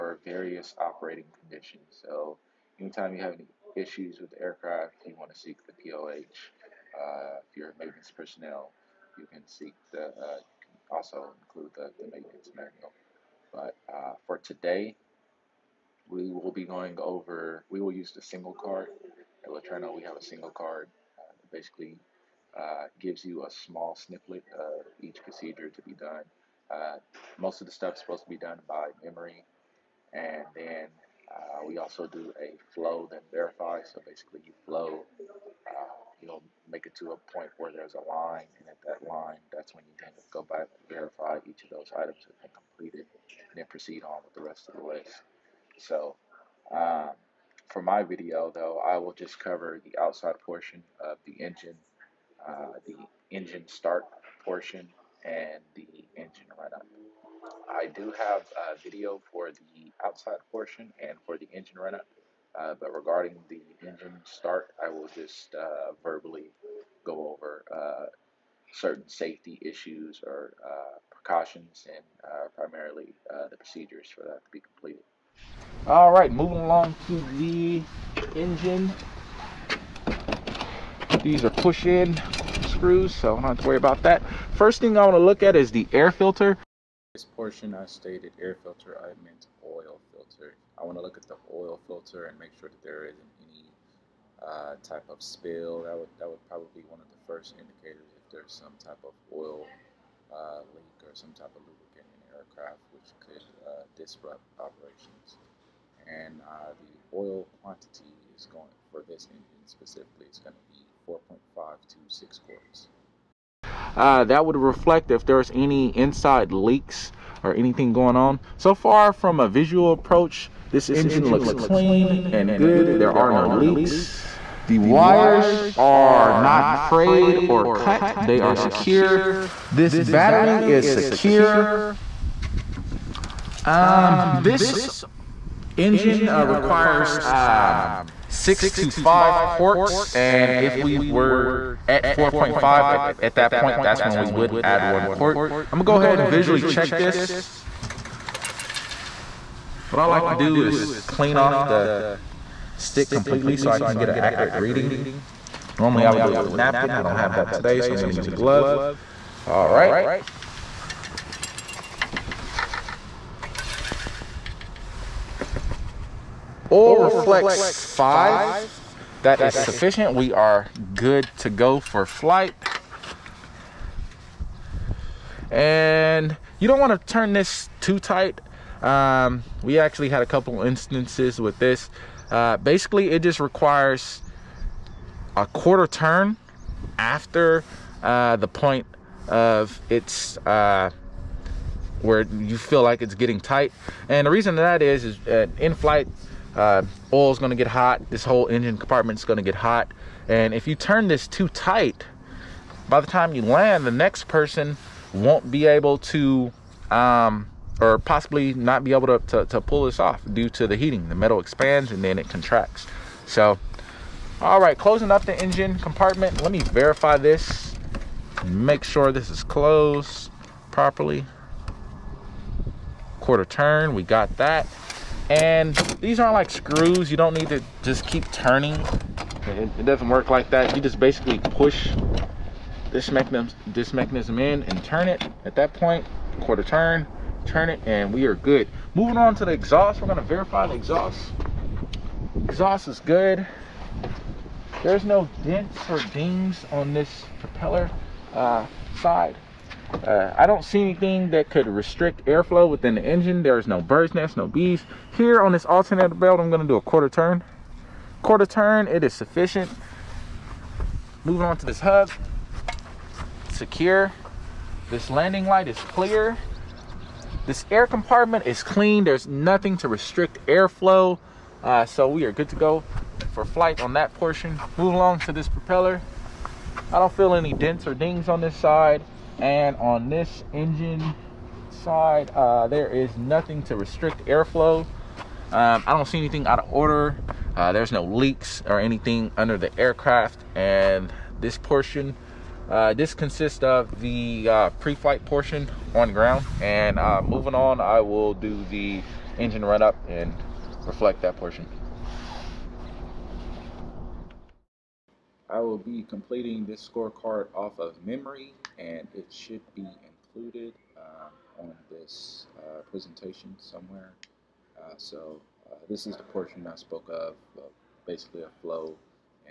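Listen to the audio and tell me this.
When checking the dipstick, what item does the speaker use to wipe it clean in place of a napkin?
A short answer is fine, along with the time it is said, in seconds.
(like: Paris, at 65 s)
glove, at 158 s.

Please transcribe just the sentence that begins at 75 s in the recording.
All right, moving along to the engine.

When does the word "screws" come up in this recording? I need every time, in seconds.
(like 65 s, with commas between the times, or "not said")
82 s, 226 s.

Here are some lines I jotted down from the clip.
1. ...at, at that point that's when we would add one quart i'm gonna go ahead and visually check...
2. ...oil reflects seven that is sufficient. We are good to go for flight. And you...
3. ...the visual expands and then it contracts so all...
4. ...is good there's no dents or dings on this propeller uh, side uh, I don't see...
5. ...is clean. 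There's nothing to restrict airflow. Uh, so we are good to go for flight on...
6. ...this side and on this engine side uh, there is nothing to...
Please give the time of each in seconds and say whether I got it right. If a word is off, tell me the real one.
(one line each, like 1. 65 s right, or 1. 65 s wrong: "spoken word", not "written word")
1. 142 s right
2. 166 s wrong: "five", not "seven"
3. 211 s wrong: "metal", not "visual"
4. 242 s right
5. 268 s right
6. 278 s right.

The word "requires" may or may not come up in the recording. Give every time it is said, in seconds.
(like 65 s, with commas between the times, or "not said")
136 s, 183 s.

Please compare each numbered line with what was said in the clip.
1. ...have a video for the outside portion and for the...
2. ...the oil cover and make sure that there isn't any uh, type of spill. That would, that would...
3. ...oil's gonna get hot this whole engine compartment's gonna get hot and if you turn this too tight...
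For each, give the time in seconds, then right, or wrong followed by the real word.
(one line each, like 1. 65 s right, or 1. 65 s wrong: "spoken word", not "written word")
1. 58 s right
2. 91 s wrong: "filter", not "cover"
3. 197 s right.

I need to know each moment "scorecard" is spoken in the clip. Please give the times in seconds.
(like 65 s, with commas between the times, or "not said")
306 s.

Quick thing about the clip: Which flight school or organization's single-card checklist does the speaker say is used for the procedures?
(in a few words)
Laterno.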